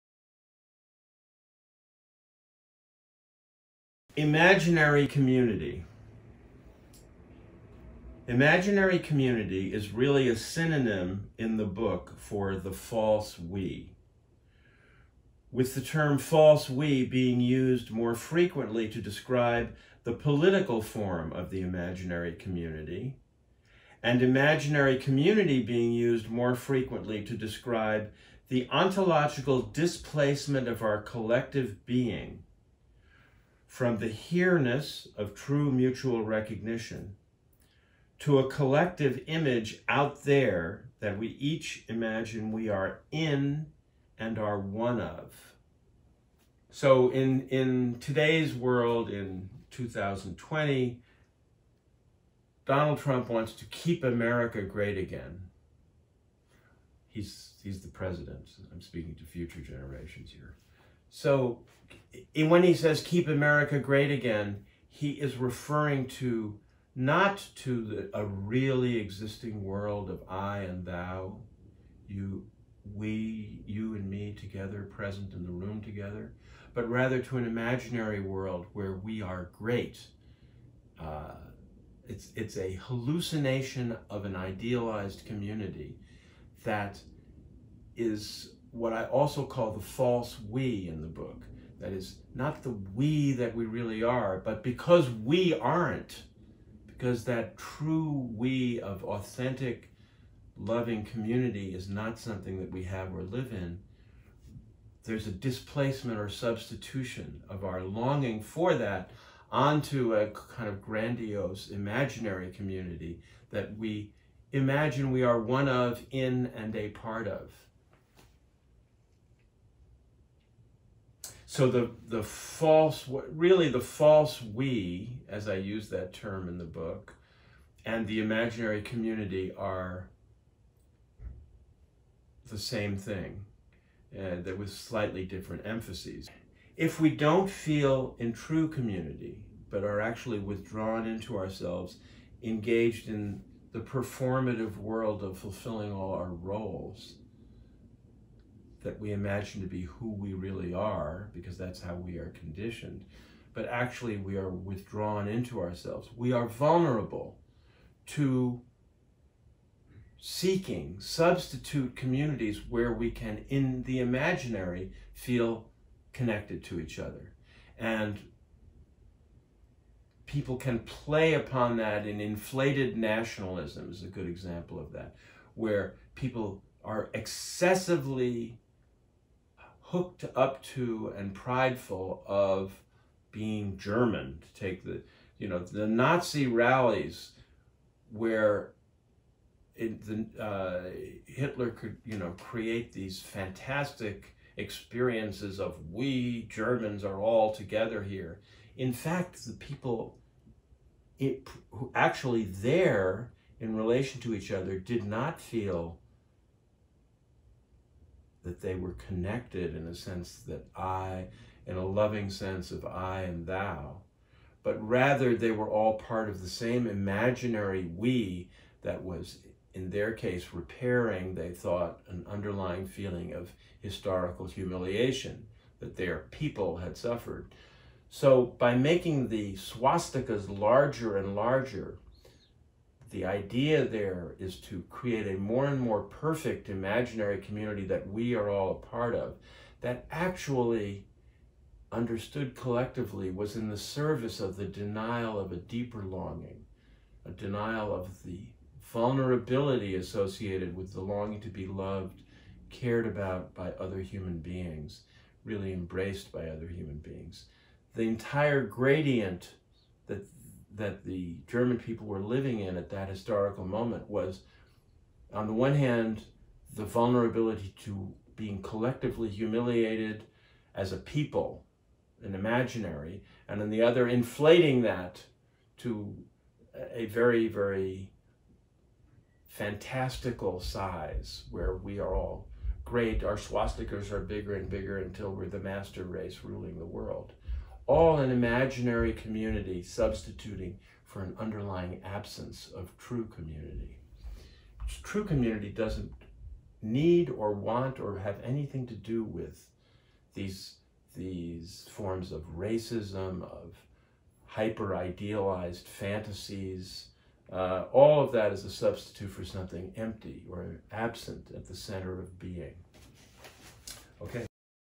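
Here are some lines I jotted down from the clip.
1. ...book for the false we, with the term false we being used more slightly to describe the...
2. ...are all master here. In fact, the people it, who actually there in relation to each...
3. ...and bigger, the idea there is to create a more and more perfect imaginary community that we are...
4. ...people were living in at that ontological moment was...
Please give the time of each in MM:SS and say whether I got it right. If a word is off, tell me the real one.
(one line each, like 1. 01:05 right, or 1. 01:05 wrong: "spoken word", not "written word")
1. 00:11 wrong: "frequently", not "slightly"
2. 03:17 wrong: "together", not "master"
3. 03:51 wrong: "larger", not "bigger"
4. 04:21 wrong: "historical", not "ontological".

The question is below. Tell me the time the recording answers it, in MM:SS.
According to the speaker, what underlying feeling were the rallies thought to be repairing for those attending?
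03:43.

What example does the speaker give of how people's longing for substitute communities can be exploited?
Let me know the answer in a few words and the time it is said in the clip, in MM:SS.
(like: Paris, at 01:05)
inflated nationalism, at 02:52.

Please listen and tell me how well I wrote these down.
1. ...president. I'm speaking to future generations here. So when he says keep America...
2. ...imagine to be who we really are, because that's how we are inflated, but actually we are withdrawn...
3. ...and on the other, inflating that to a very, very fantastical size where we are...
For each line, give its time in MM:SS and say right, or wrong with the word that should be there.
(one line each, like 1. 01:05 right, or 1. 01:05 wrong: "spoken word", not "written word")
1. 00:57 right
2. 02:29 wrong: "conditioned", not "inflated"
3. 04:33 right.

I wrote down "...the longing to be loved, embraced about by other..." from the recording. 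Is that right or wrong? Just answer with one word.
wrong.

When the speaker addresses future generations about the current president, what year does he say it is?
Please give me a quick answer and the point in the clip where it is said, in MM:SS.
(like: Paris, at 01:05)
2020, at 00:49.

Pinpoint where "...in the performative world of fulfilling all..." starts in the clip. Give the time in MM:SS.
02:23.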